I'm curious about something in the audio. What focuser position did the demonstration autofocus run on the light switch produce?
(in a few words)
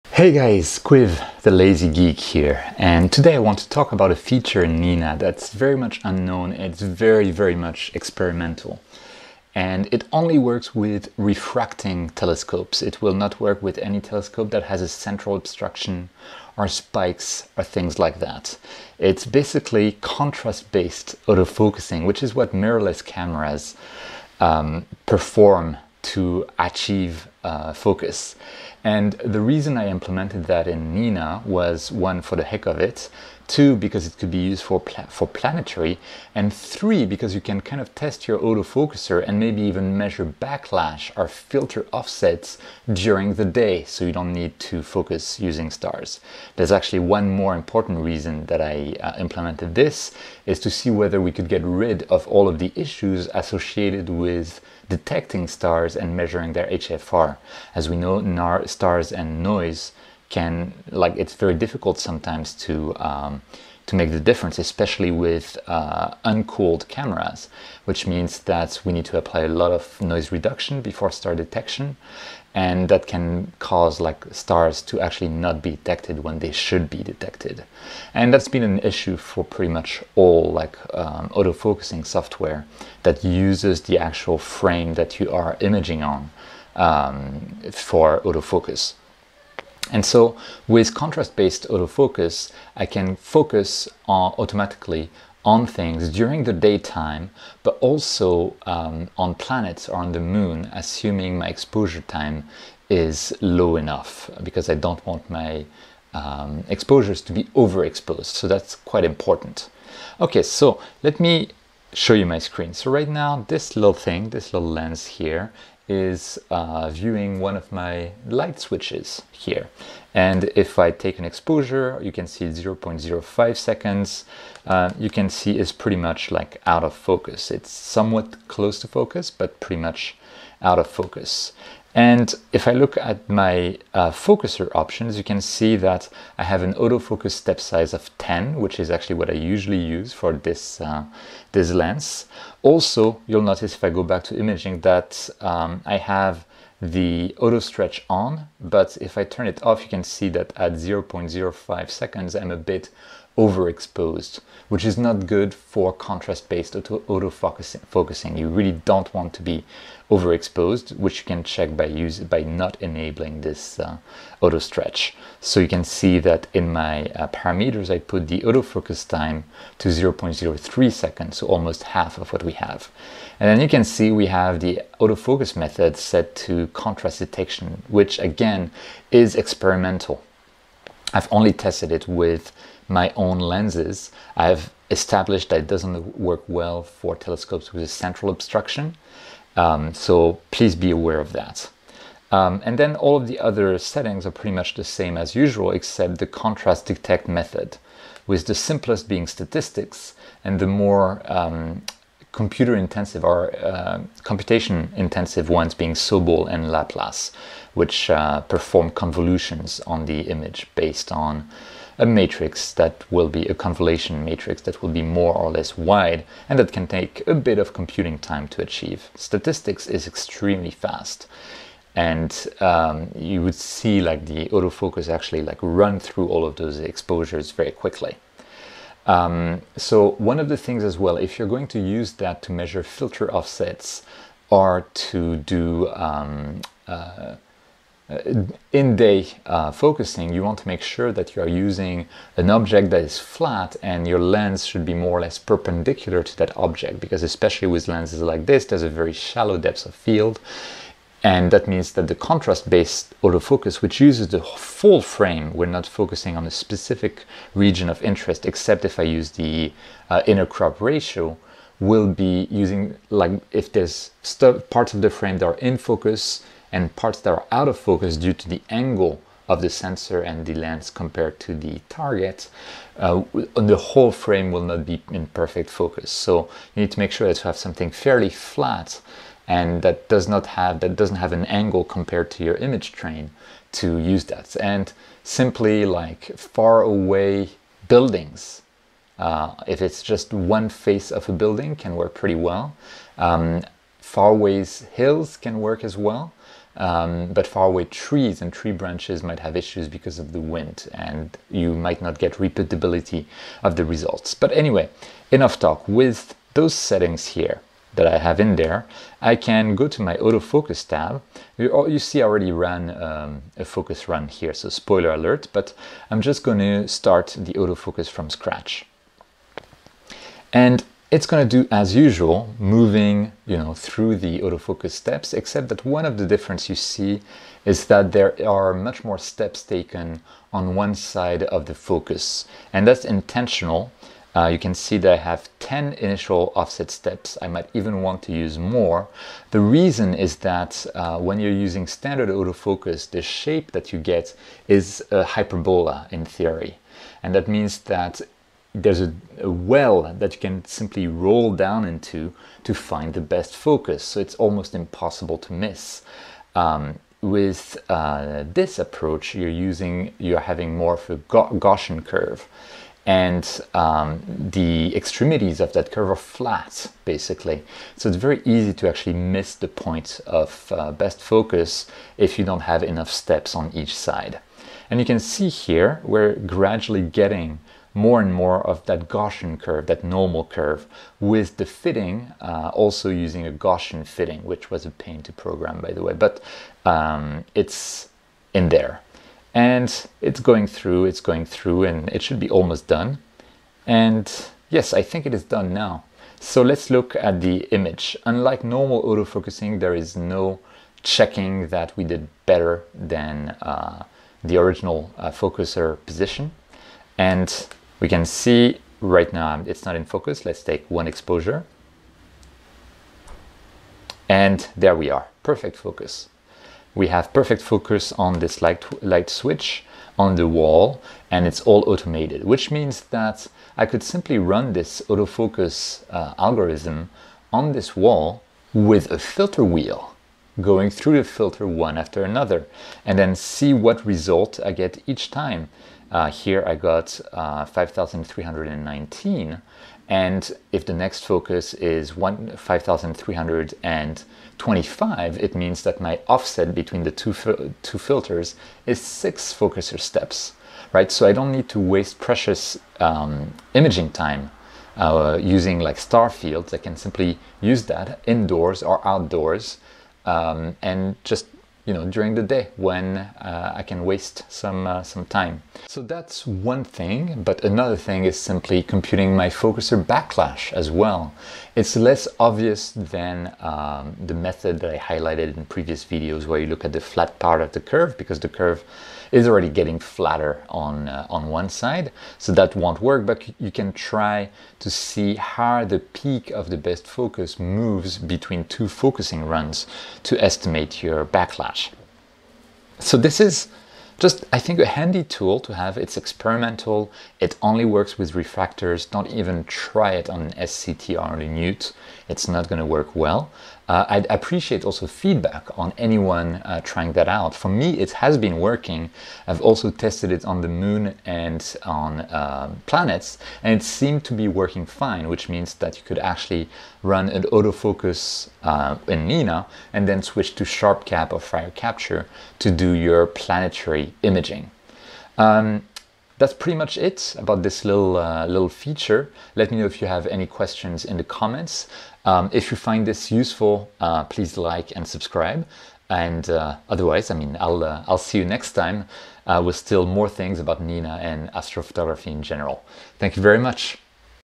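5,319.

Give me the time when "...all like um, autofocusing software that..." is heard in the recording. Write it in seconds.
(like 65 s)
80 s.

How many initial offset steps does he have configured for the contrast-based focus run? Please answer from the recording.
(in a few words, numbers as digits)
10.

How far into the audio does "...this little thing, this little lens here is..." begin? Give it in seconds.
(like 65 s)
113 s.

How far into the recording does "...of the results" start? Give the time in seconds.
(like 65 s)
303 s.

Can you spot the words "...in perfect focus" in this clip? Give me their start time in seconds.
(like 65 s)
275 s.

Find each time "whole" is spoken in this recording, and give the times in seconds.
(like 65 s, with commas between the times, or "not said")
273 s.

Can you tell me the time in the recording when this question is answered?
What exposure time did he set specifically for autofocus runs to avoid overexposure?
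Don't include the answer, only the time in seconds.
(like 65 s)
169 s.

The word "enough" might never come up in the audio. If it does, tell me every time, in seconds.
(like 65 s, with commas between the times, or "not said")
103 s, 305 s, 372 s.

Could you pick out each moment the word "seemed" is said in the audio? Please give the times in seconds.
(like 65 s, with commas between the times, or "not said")
513 s.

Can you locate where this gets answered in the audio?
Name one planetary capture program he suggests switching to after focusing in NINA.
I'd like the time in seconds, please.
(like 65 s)
520 s.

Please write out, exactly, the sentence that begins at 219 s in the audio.
Statistics is extremely fast and um, you would see like the autofocus actually like run through all of those exposures very quickly.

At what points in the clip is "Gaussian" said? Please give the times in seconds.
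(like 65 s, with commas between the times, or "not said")
361 s, 379 s, 383 s.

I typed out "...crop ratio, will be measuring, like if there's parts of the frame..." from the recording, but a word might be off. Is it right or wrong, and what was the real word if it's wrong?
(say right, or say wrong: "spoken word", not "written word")
wrong: "using", not "measuring".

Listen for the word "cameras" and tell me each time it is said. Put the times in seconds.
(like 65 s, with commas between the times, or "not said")
23 s, 66 s.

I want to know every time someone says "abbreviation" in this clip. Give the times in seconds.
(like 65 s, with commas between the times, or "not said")
not said.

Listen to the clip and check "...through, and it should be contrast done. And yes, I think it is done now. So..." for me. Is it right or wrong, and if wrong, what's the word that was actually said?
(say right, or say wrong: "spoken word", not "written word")
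wrong: "almost", not "contrast".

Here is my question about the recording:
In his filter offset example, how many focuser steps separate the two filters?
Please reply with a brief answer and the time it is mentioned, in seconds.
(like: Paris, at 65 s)
6, at 448 s.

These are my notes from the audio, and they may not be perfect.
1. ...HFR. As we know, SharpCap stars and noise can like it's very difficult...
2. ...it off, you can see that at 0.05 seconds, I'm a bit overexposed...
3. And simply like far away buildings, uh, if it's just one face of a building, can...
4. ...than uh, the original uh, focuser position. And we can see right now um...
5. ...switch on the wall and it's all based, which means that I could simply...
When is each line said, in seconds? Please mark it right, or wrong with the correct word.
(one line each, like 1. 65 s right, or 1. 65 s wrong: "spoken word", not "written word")
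1. 56 s wrong: "NAR", not "SharpCap"
2. 149 s right
3. 284 s right
4. 402 s right
5. 419 s wrong: "automated", not "based".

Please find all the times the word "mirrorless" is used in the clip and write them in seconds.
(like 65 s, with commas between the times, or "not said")
22 s.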